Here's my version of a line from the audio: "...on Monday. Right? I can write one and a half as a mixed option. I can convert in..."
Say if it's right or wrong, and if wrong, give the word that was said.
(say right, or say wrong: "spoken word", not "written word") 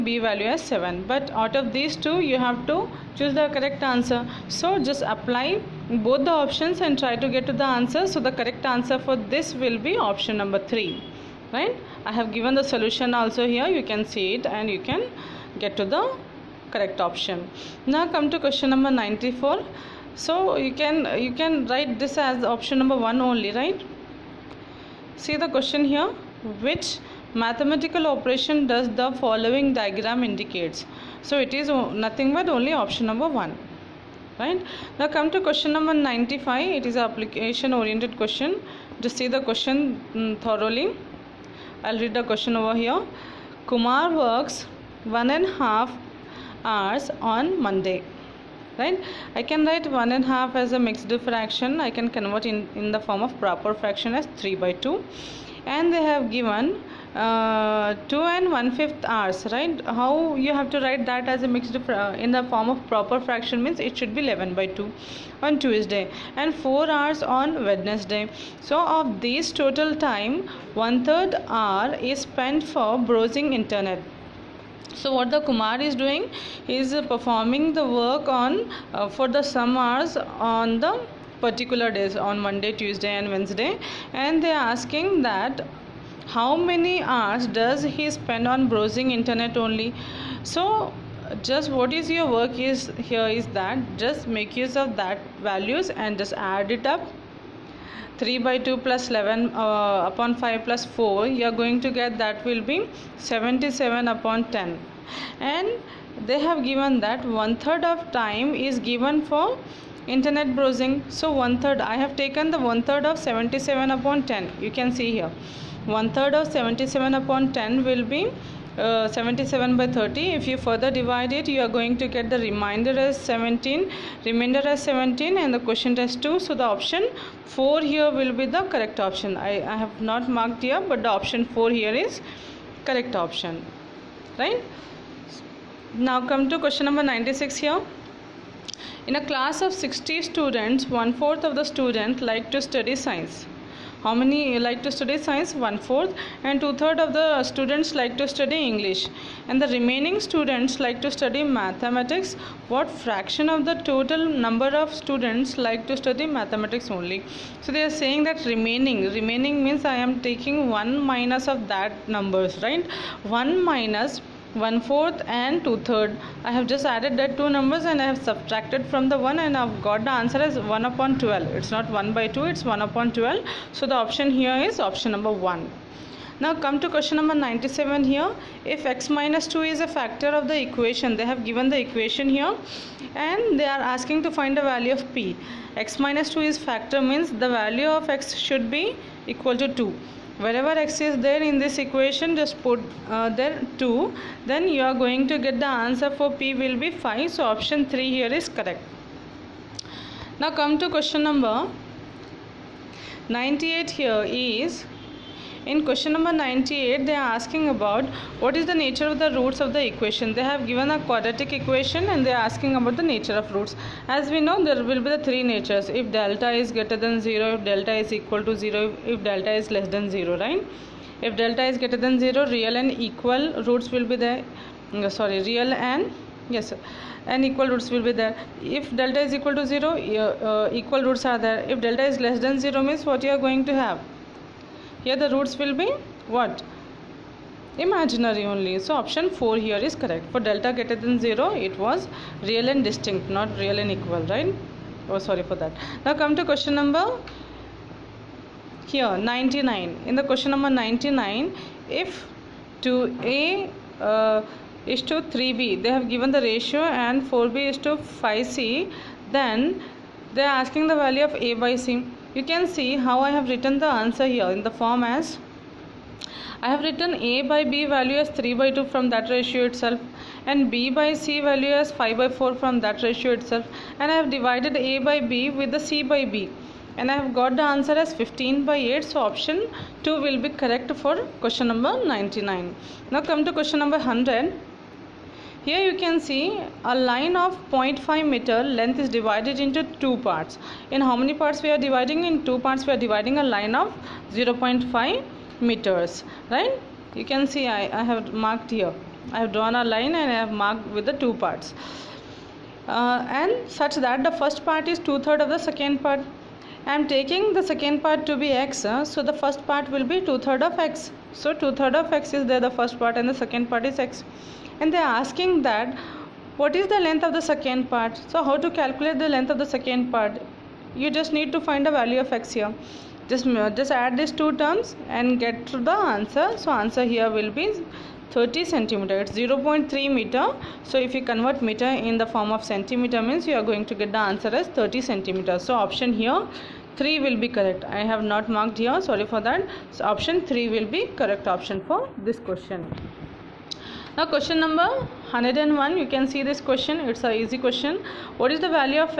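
wrong: "fraction", not "option".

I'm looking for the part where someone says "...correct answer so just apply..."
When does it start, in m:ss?
0:03.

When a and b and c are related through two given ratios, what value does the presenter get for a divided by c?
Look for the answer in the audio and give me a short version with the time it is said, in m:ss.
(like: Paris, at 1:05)
15/8, at 4:38.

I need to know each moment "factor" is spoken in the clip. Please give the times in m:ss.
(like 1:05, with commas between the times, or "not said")
2:59, 3:06.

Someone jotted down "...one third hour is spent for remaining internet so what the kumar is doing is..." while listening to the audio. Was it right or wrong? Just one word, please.
wrong.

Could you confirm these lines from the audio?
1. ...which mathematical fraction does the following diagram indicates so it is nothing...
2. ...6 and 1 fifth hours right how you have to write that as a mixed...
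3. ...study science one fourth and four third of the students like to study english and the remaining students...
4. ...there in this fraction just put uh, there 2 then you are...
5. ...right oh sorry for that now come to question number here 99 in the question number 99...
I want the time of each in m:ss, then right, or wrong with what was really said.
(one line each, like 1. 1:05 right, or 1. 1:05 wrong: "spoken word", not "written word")
1. 0:26 wrong: "operation", not "fraction"
2. 0:58 wrong: "2", not "6"
3. 2:24 wrong: "two", not "four"
4. 3:11 wrong: "equation", not "fraction"
5. 4:04 right.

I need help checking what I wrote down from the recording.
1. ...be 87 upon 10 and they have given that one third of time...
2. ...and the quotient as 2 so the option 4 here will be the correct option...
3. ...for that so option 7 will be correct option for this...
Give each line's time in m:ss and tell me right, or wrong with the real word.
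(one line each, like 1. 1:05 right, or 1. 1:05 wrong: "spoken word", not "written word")
1. 1:42 wrong: "77", not "87"
2. 2:05 right
3. 5:39 wrong: "3", not "7".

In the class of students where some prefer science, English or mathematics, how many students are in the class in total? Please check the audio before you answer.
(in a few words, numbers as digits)
60.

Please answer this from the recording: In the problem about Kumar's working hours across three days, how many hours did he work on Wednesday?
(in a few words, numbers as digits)
4 hours.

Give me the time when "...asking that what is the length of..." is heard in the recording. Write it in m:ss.
5:15.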